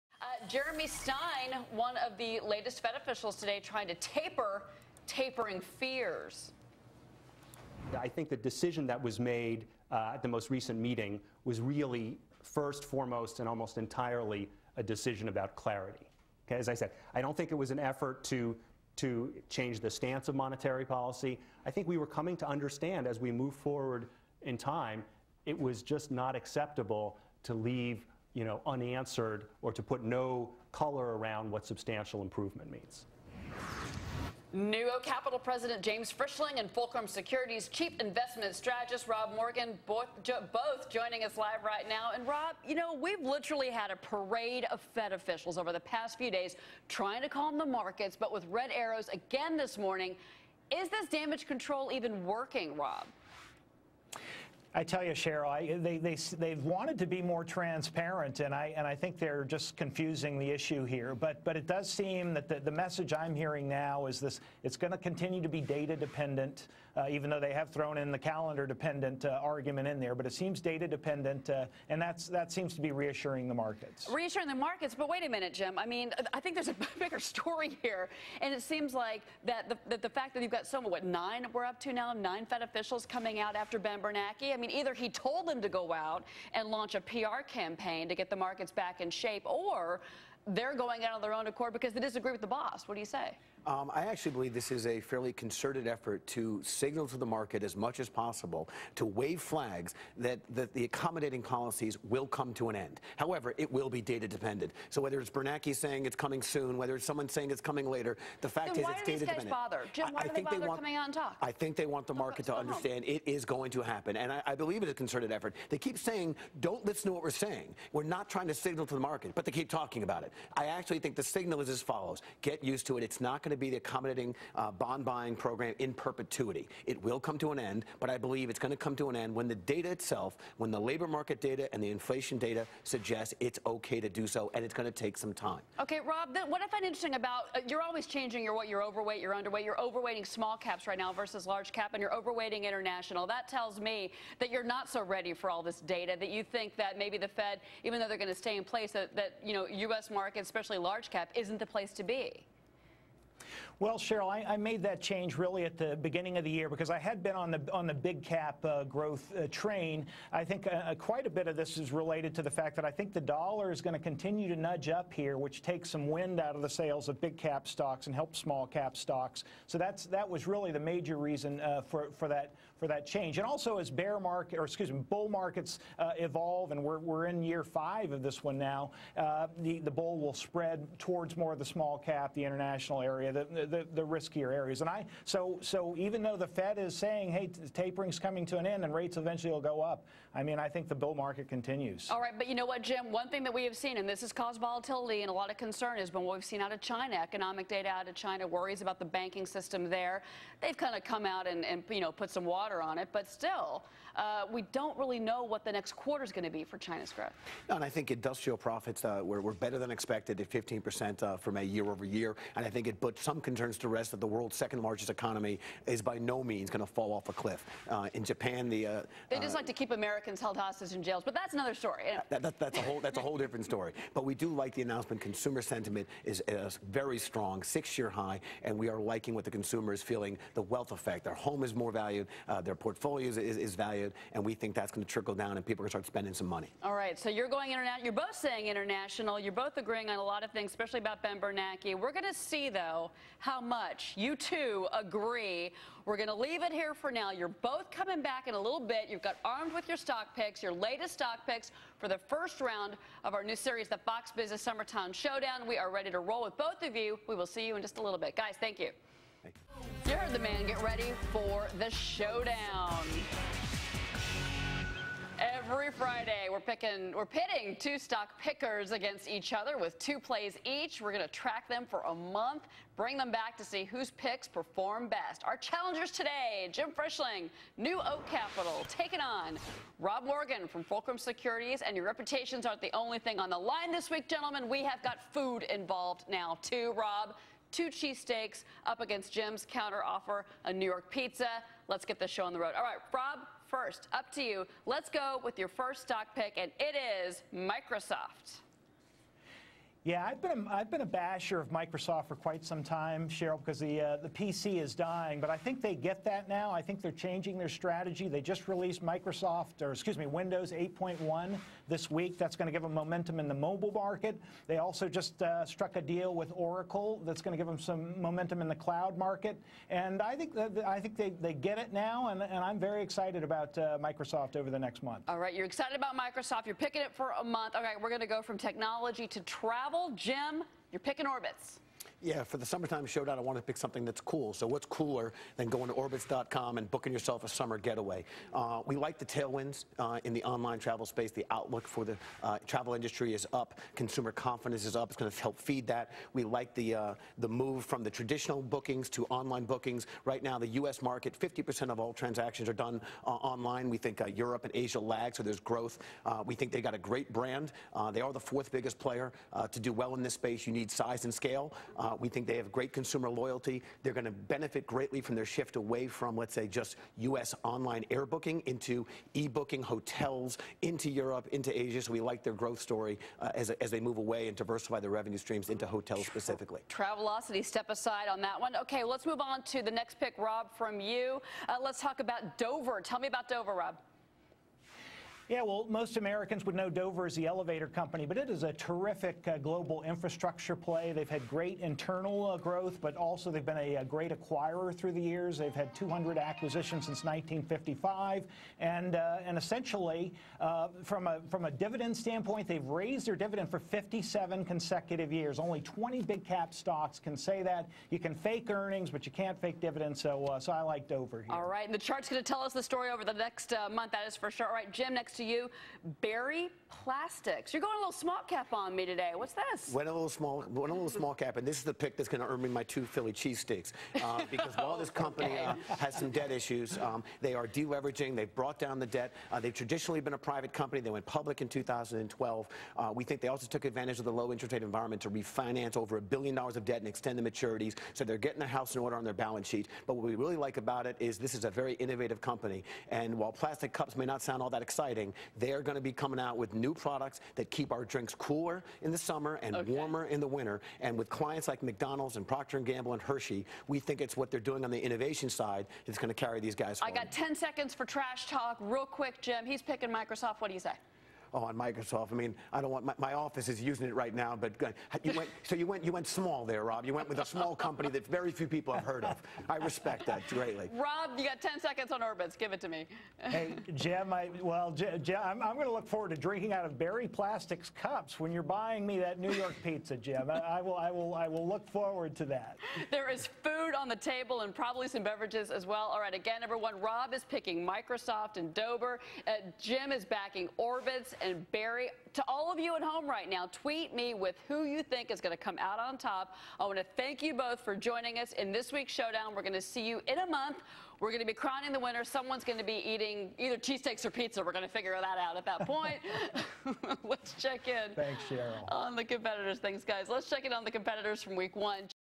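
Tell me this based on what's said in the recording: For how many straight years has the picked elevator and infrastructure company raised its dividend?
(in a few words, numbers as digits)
57.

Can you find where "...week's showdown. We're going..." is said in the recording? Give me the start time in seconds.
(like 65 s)
498 s.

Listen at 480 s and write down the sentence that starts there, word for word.
I, I will, I will, I will look forward to that.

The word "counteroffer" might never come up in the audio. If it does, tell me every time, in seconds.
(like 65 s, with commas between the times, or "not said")
289 s.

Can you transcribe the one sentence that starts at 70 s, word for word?
But it seems data dependent, uh, and that's, that seems to be reassuring the markets.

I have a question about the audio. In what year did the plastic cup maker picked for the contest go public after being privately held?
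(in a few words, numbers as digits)
2012.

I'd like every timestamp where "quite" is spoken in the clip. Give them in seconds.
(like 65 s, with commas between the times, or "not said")
160 s, 302 s.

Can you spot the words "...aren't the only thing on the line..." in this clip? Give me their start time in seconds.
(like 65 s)
282 s.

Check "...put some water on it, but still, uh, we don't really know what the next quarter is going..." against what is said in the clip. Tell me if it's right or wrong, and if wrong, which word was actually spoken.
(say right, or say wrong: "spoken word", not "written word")
right.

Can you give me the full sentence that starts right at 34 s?
NewOak Capital President James Frischling and Fulcrum Securities Chief Investment Strategist Rob Morgan both, jo both, joining us live right now.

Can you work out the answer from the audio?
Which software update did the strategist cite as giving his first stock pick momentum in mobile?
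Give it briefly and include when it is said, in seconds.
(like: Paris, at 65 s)
Windows 8.1, at 310 s.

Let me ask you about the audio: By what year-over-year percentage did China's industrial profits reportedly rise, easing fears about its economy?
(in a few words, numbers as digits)
15%.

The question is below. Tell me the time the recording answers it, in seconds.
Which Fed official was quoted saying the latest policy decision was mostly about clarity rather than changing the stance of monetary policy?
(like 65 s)
0 s.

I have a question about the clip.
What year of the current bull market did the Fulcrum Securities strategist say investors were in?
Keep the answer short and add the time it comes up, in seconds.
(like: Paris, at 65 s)
5, at 177 s.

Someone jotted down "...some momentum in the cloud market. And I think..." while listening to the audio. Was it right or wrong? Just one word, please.
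right.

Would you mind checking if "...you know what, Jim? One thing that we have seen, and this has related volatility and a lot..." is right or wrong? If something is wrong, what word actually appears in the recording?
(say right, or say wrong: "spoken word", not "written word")
wrong: "caused", not "related".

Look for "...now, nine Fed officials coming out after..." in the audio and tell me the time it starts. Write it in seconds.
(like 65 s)
81 s.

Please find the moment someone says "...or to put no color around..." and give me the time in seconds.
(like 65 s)
29 s.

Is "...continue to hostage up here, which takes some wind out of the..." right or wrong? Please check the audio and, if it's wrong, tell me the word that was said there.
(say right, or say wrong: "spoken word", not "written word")
wrong: "nudge", not "hostage".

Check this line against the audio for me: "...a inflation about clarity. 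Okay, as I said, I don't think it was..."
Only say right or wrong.
wrong.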